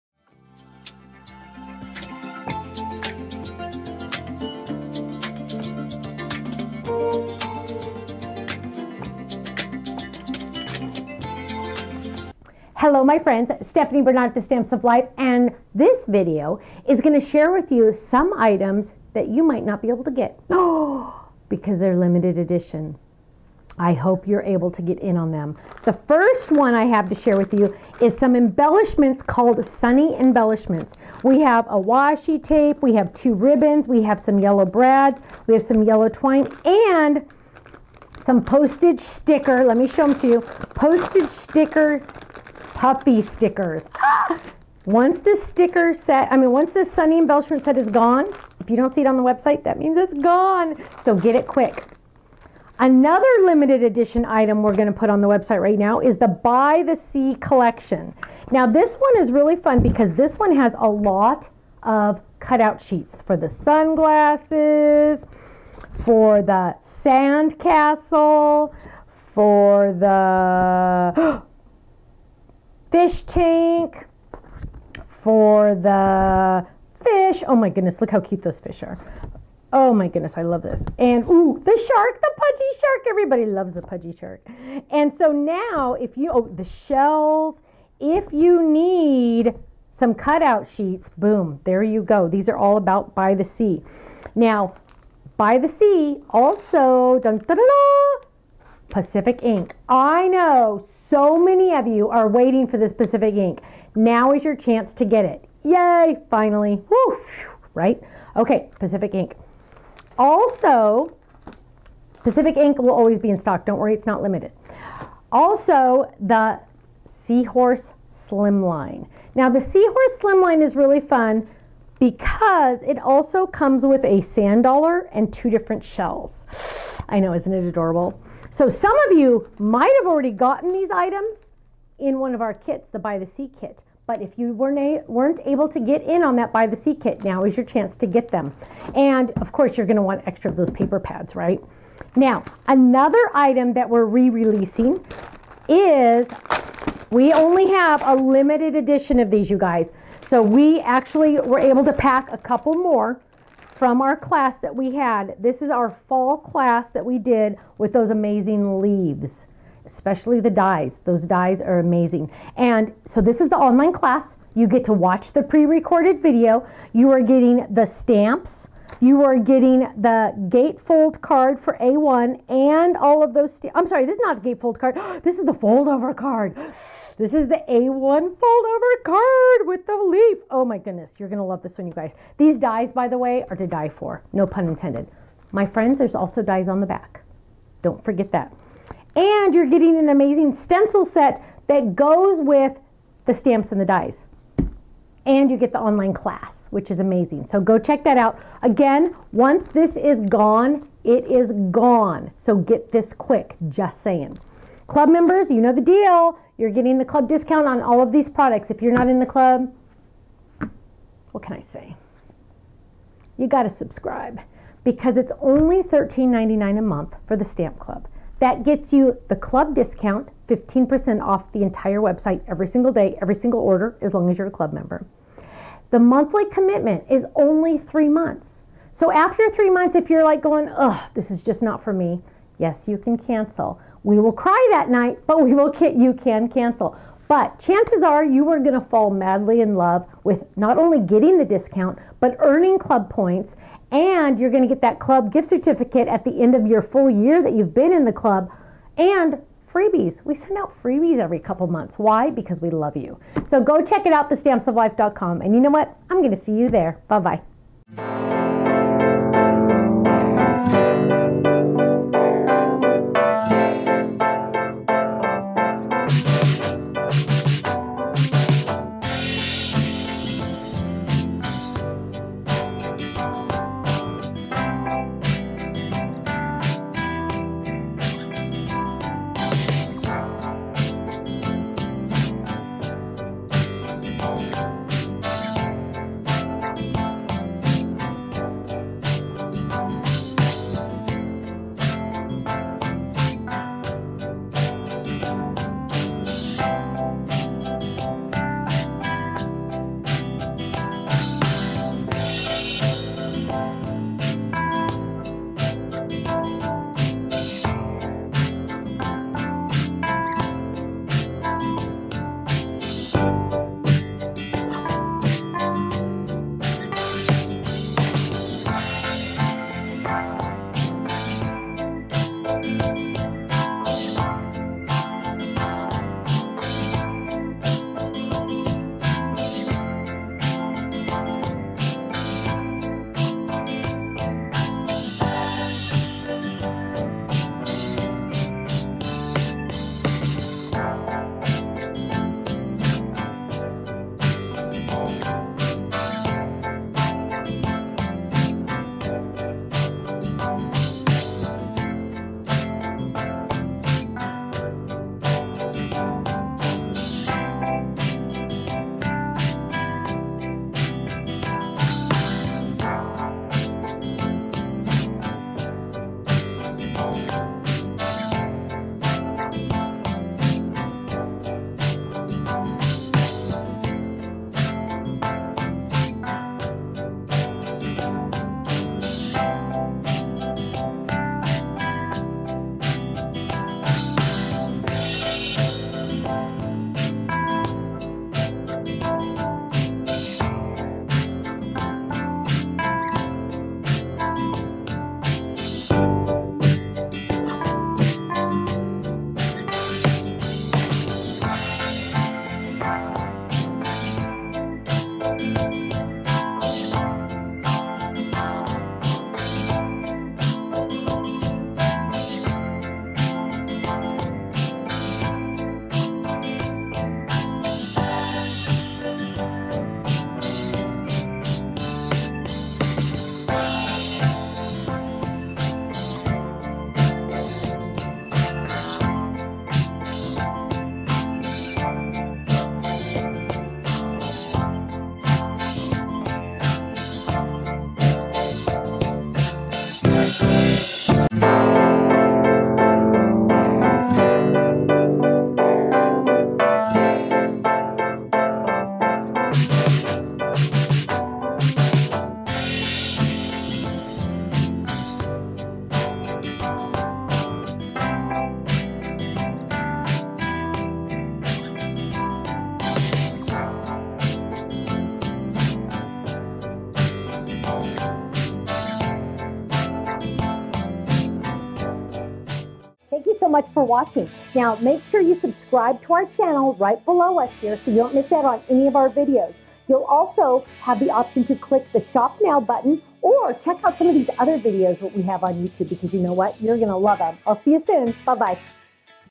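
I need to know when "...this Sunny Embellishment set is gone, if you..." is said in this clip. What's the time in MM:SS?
00:46.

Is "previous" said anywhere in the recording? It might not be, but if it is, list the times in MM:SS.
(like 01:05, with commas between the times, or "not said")
not said.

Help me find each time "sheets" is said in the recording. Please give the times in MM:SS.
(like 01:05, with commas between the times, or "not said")
01:02, 01:30.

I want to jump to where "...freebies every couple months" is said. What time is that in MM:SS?
04:10.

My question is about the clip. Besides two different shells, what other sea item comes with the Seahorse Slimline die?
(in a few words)
Sand dollar.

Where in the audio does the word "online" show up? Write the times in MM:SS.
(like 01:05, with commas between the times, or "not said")
02:43, 03:15.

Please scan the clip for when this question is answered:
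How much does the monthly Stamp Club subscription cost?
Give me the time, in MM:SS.
03:35.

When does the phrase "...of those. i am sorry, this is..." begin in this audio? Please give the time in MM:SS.
02:53.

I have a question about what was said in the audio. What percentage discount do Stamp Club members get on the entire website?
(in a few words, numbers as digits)
15%.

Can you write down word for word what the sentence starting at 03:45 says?
The monthly commitment is only three months.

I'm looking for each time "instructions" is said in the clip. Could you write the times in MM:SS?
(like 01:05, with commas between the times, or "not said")
not said.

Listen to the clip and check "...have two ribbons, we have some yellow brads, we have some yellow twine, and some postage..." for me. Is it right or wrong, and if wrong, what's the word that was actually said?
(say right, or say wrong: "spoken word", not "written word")
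right.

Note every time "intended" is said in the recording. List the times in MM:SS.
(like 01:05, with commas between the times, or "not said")
03:04.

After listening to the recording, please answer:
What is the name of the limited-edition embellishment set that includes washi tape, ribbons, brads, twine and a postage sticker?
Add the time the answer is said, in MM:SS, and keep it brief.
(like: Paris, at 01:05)
Sunny Embellishments, at 00:29.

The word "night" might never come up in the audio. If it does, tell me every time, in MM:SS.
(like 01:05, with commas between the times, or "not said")
03:54.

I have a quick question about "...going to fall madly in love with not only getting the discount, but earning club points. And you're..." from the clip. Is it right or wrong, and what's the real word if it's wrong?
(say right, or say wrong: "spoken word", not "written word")
right.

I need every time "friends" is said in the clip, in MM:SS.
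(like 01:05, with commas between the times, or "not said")
00:13, 03:05.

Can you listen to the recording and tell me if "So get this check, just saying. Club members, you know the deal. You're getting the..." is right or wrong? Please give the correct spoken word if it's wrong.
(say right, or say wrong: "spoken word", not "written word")
wrong: "quick", not "check".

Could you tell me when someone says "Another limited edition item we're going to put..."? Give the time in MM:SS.
00:52.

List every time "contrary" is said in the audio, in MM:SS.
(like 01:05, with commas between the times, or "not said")
not said.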